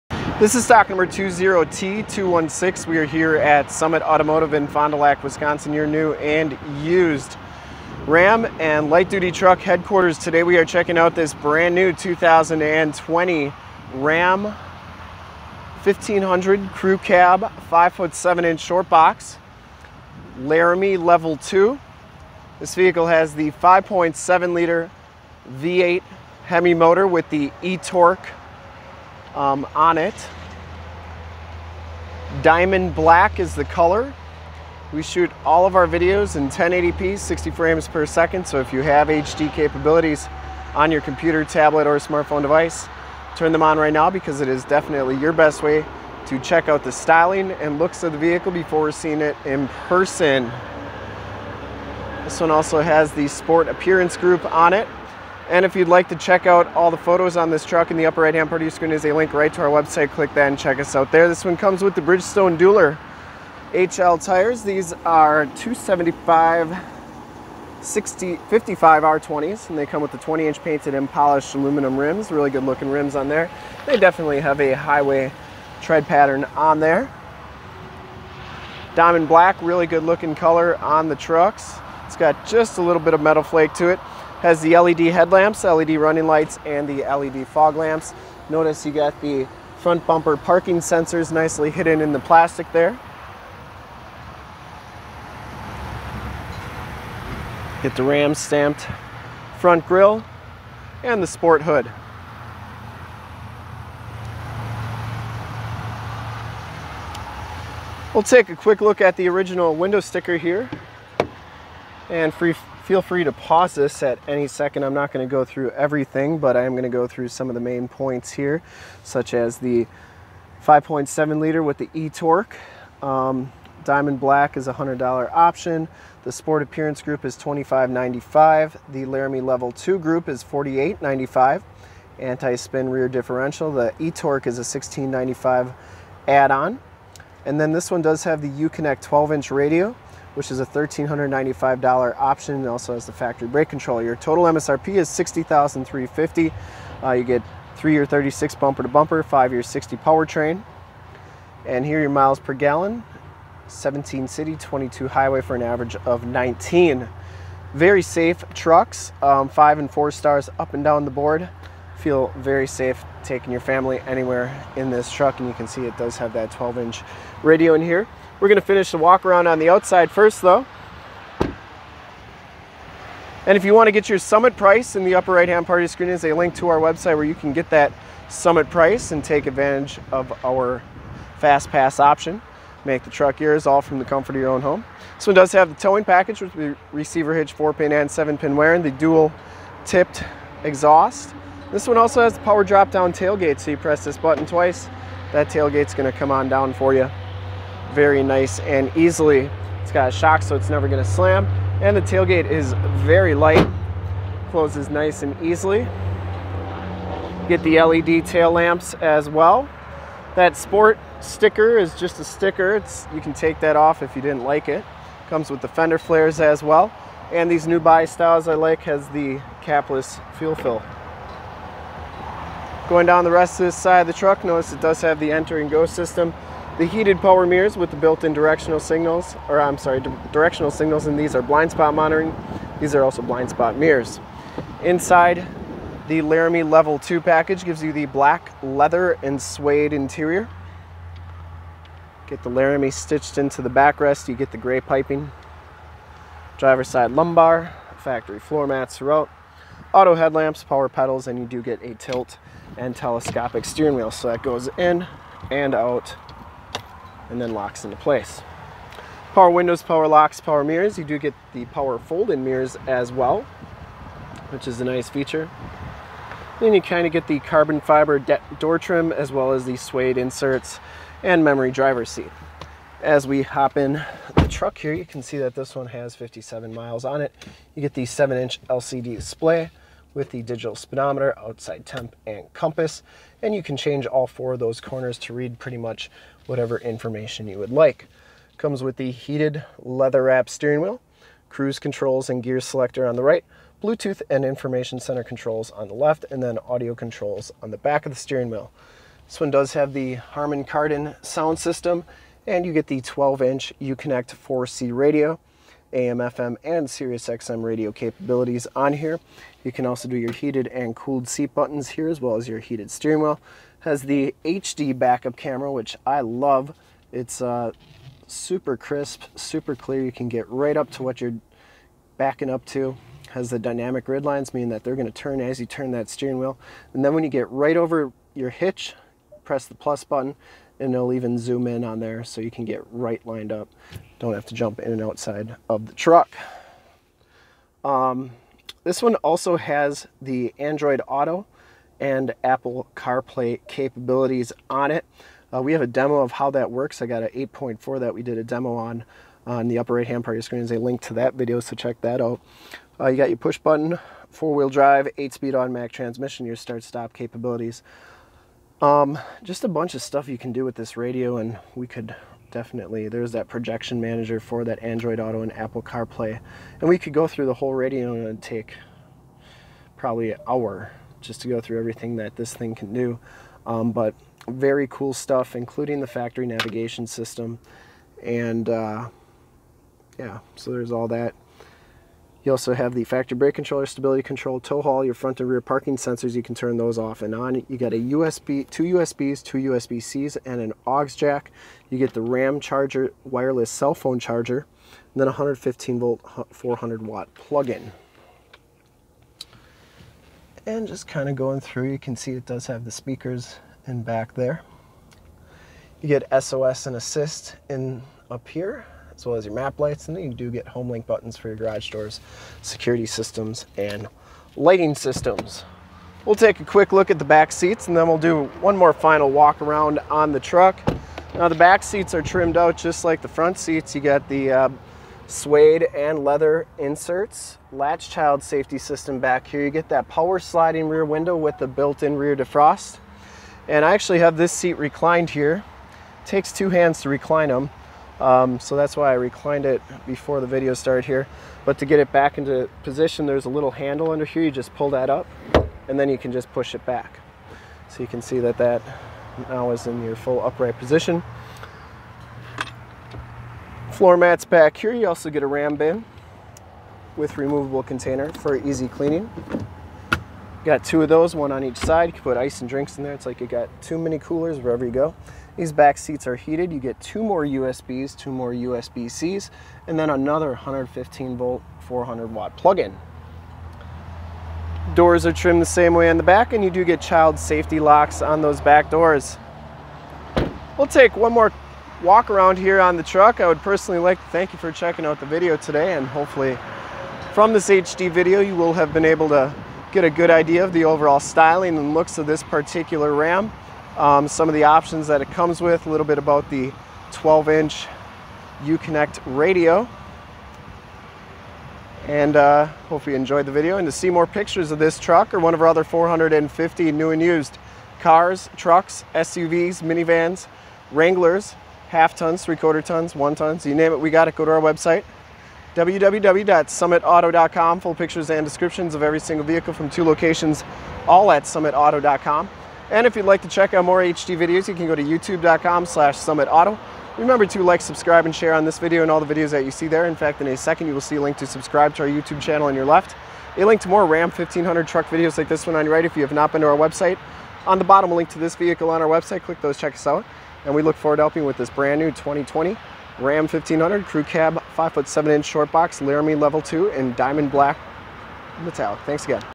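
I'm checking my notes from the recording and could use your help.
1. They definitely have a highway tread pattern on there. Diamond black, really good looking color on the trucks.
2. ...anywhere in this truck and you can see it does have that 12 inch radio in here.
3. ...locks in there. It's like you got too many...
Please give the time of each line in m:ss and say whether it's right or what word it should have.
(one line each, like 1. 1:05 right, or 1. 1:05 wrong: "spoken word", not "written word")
1. 1:13 right
2. 2:44 right
3. 7:42 wrong: "drinks", not "locks".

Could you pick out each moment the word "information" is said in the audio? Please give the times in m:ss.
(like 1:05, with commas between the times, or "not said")
4:46, 4:54.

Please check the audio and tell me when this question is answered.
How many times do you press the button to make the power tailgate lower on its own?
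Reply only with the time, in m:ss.
3:14.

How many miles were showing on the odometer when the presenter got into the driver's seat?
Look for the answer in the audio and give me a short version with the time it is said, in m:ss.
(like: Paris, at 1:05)
57, at 4:36.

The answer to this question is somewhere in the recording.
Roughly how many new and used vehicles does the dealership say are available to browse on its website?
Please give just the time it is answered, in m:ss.
8:25.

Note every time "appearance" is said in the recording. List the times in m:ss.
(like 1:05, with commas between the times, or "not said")
0:53, 2:06.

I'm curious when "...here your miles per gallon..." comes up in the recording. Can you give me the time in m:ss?
2:31.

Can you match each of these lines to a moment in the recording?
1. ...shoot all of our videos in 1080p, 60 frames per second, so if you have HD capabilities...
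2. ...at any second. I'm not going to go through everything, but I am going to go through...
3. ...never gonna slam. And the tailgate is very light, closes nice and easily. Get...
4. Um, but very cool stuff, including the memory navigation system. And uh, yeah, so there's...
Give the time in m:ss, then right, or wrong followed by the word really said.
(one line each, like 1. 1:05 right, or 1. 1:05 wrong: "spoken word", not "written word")
1. 0:35 right
2. 1:54 right
3. 3:20 right
4. 6:13 wrong: "factory", not "memory".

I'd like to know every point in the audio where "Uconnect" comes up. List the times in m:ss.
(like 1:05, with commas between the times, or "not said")
2:18, 5:03, 8:18.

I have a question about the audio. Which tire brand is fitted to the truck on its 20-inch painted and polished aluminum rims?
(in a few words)
Bridgestone.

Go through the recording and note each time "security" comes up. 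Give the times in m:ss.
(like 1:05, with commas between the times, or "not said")
6:52.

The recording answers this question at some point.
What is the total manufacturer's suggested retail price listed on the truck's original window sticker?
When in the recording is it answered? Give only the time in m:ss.
2:25.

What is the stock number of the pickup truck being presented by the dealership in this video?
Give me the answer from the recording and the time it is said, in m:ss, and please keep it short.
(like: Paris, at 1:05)
20T216, at 0:01.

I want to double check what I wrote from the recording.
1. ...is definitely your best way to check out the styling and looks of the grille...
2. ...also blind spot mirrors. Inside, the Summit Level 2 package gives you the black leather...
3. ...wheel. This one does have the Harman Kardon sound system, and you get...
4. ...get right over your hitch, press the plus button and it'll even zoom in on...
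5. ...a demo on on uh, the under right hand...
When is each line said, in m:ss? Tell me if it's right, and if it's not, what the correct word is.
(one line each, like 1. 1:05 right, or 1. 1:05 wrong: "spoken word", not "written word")
1. 0:44 wrong: "vehicle", not "grille"
2. 3:53 wrong: "Laramie", not "Summit"
3. 4:58 right
4. 5:27 right
5. 5:48 wrong: "upper", not "under".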